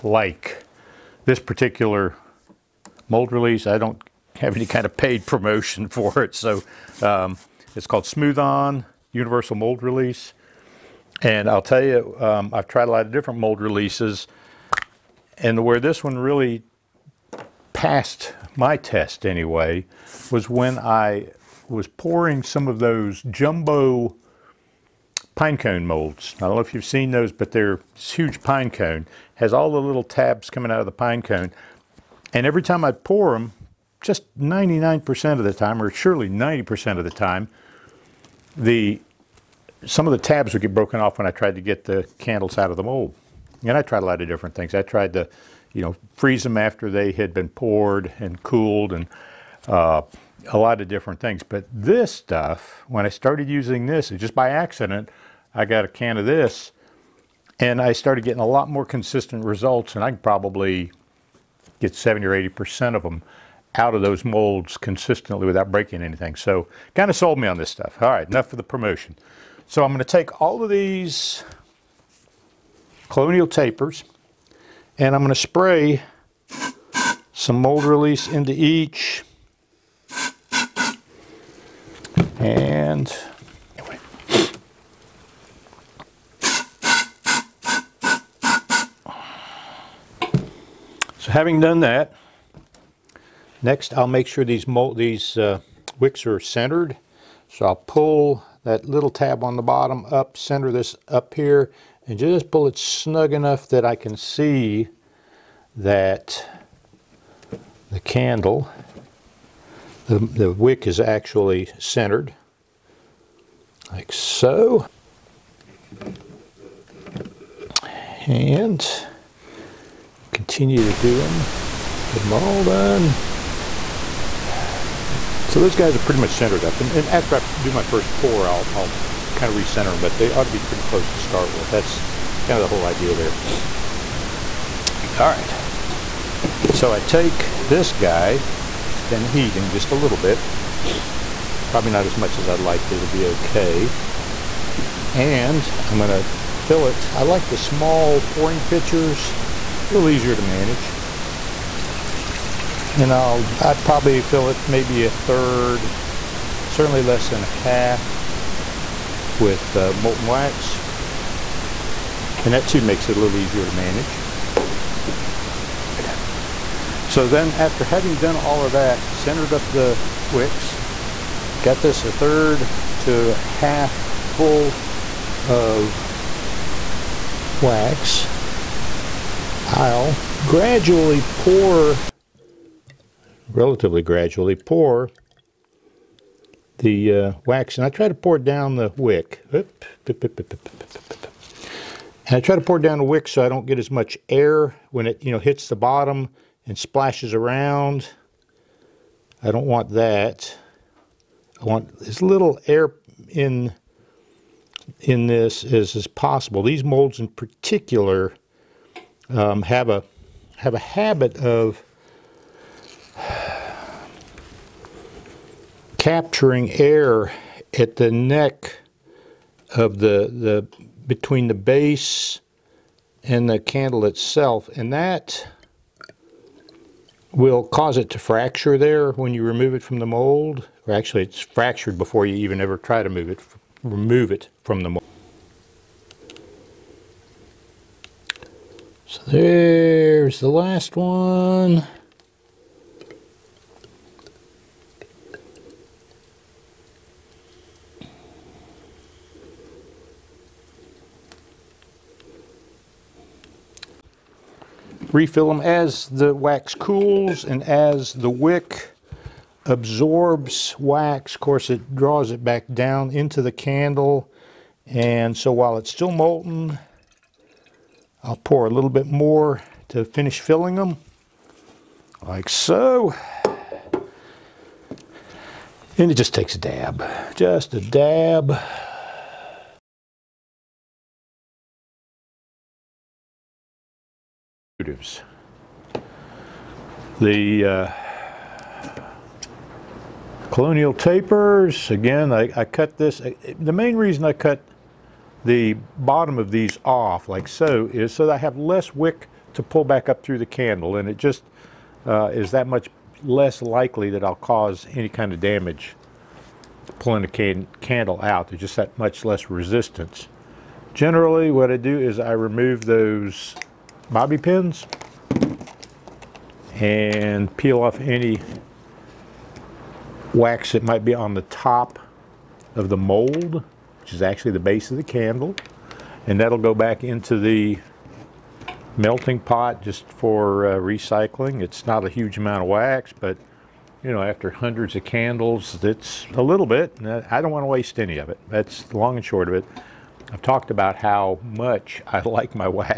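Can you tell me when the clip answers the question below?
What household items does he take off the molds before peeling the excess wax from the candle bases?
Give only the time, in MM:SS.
05:14.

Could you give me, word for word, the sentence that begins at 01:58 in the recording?
And continue to do them, get them all done.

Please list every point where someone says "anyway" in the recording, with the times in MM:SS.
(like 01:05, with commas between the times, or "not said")
00:19, 01:23.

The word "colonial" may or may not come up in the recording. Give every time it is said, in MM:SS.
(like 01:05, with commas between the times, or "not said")
01:13, 04:50.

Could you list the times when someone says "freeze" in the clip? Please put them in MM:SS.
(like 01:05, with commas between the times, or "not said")
00:46.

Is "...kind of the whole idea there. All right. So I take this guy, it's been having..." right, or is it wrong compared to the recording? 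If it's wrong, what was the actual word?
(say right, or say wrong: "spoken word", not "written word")
wrong: "heating", not "having".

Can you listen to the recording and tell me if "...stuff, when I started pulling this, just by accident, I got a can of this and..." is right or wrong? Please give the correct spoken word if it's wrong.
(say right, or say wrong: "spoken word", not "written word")
wrong: "using", not "pulling".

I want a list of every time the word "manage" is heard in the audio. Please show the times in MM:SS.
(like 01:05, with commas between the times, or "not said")
02:30, 02:43.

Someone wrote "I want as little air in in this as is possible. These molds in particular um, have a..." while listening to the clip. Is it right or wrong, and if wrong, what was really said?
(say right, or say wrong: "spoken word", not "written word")
right.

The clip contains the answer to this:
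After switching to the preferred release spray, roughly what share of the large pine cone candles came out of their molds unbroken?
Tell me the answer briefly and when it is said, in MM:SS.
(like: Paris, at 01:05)
70 or 80%, at 01:01.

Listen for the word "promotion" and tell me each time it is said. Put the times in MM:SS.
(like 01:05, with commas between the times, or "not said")
00:05, 01:08.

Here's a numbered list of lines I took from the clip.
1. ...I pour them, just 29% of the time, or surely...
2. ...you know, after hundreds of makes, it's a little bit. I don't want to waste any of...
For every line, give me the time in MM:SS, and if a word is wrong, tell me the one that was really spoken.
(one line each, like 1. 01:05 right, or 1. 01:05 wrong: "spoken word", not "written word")
1. 00:32 wrong: "99", not "29"
2. 05:34 wrong: "candles", not "makes".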